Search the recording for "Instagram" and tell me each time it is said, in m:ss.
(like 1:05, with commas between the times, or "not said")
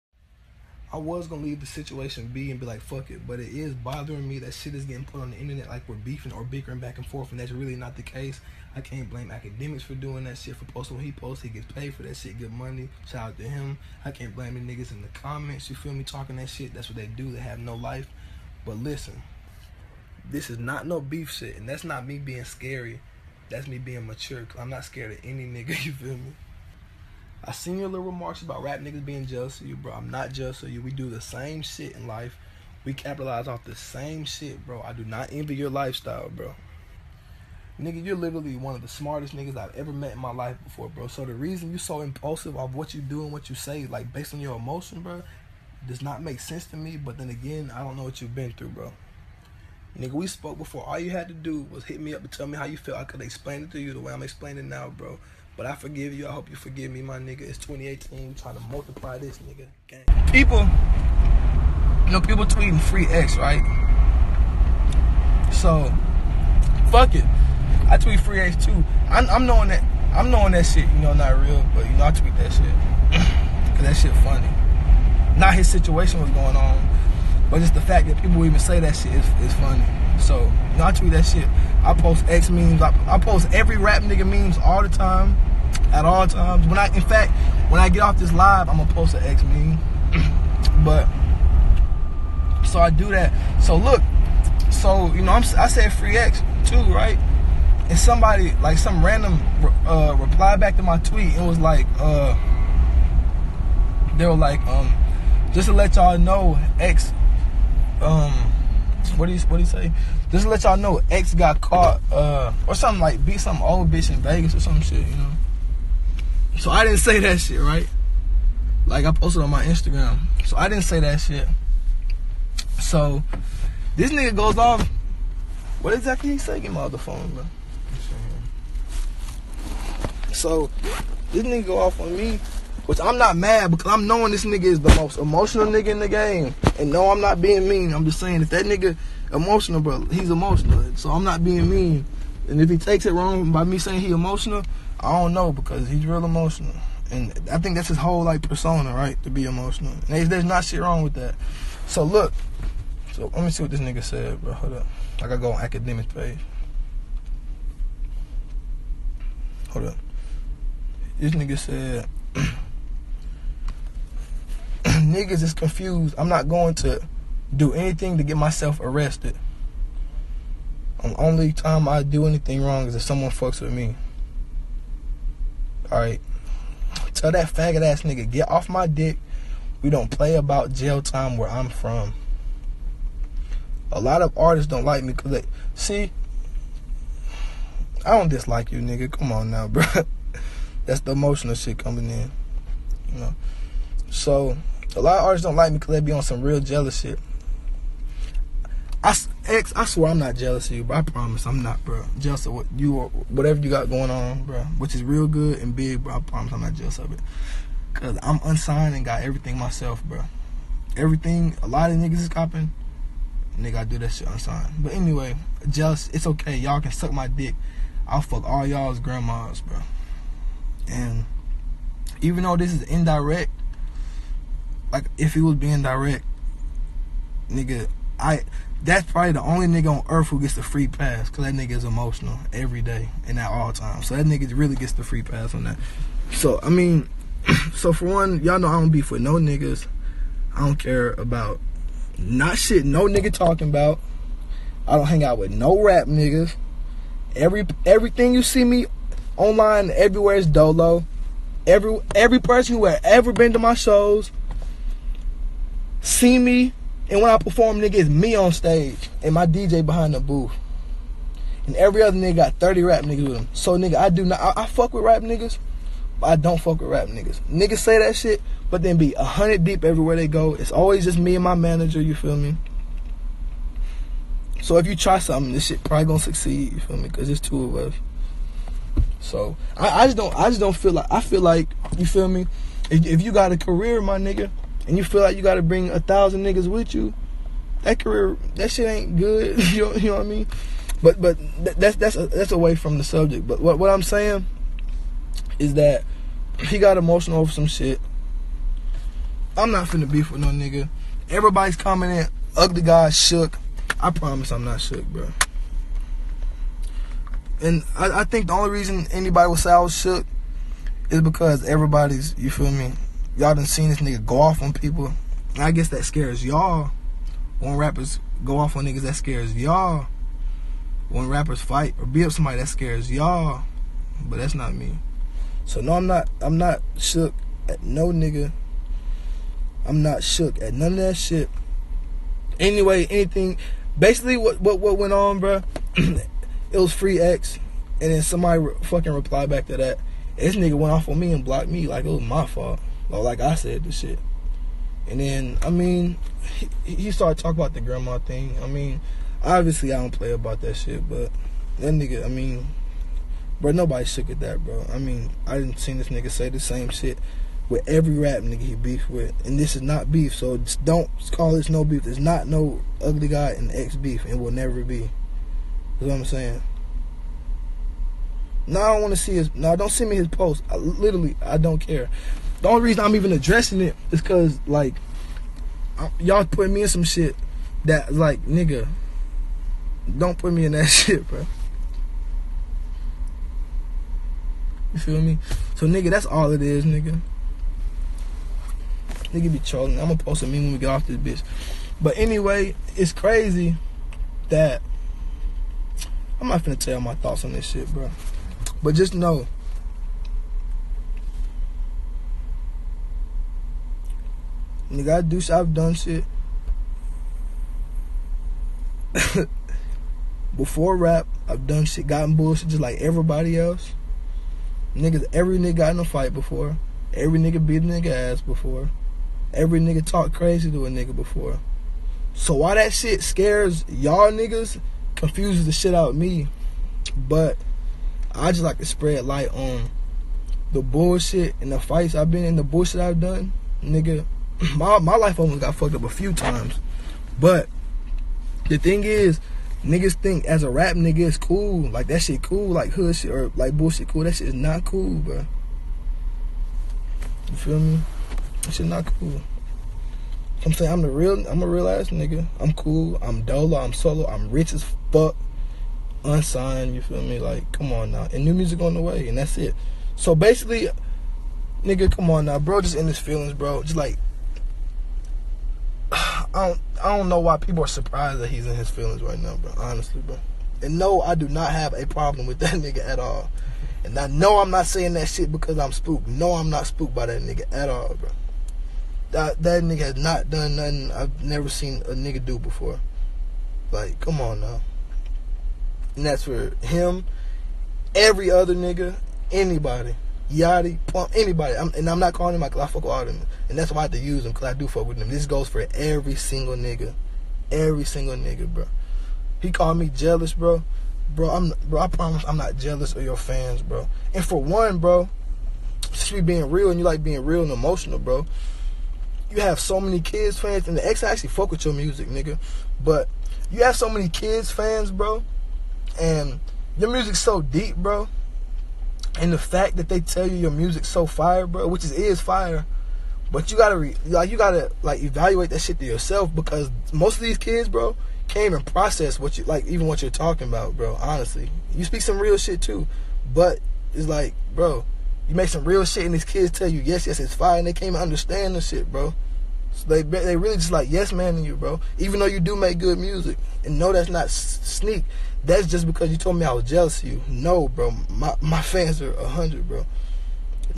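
1:59.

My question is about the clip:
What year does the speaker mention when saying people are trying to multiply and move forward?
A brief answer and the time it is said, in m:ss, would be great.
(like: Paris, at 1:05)
2018, at 0:57.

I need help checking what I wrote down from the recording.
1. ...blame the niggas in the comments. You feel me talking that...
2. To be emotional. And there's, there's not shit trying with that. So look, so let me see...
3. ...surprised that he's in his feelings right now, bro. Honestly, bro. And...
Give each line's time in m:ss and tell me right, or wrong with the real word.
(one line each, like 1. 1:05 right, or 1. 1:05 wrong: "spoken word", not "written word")
1. 0:14 right
2. 2:29 wrong: "wrong", not "trying"
3. 7:47 right.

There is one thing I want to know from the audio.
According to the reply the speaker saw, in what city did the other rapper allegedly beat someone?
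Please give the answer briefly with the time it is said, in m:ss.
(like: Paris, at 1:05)
Vegas, at 1:54.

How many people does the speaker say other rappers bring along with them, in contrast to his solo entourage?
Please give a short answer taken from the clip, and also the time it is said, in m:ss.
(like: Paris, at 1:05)
30, at 4:22.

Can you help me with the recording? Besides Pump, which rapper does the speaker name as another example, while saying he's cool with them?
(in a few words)
Yachty.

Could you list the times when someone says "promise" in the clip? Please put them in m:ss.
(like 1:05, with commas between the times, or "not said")
3:21, 3:26, 5:04, 8:22.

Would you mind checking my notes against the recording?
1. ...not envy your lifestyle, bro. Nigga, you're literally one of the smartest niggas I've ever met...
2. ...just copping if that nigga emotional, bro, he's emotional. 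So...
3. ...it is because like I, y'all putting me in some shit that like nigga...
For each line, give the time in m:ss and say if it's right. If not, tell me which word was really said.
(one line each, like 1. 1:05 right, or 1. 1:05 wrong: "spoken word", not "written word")
1. 0:35 right
2. 2:18 wrong: "saying", not "copping"
3. 6:13 right.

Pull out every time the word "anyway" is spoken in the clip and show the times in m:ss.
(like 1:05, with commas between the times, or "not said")
3:34, 5:32, 6:32.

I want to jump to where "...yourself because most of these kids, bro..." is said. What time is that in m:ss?
8:46.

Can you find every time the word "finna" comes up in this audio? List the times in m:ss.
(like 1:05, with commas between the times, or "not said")
4:59, 6:36.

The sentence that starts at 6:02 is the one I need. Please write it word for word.
There's not no Ugly God in X beef, and will never be.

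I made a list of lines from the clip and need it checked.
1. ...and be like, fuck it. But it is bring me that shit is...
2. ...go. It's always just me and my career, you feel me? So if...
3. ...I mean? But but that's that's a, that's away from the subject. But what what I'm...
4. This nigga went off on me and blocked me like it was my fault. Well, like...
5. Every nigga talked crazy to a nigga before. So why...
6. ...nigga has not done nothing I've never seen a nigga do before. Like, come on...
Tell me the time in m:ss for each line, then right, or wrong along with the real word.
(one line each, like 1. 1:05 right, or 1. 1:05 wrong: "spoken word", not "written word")
1. 0:02 wrong: "bothering", not "bring"
2. 4:30 wrong: "manager", not "career"
3. 4:50 right
4. 5:40 right
5. 6:59 right
6. 7:59 right.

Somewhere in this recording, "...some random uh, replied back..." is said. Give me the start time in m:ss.
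1:38.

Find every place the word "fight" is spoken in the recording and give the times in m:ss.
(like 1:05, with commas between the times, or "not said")
5:21, 6:56, 7:11.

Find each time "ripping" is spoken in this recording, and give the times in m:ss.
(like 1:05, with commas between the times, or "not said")
not said.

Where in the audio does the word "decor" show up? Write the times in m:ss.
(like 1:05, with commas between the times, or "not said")
not said.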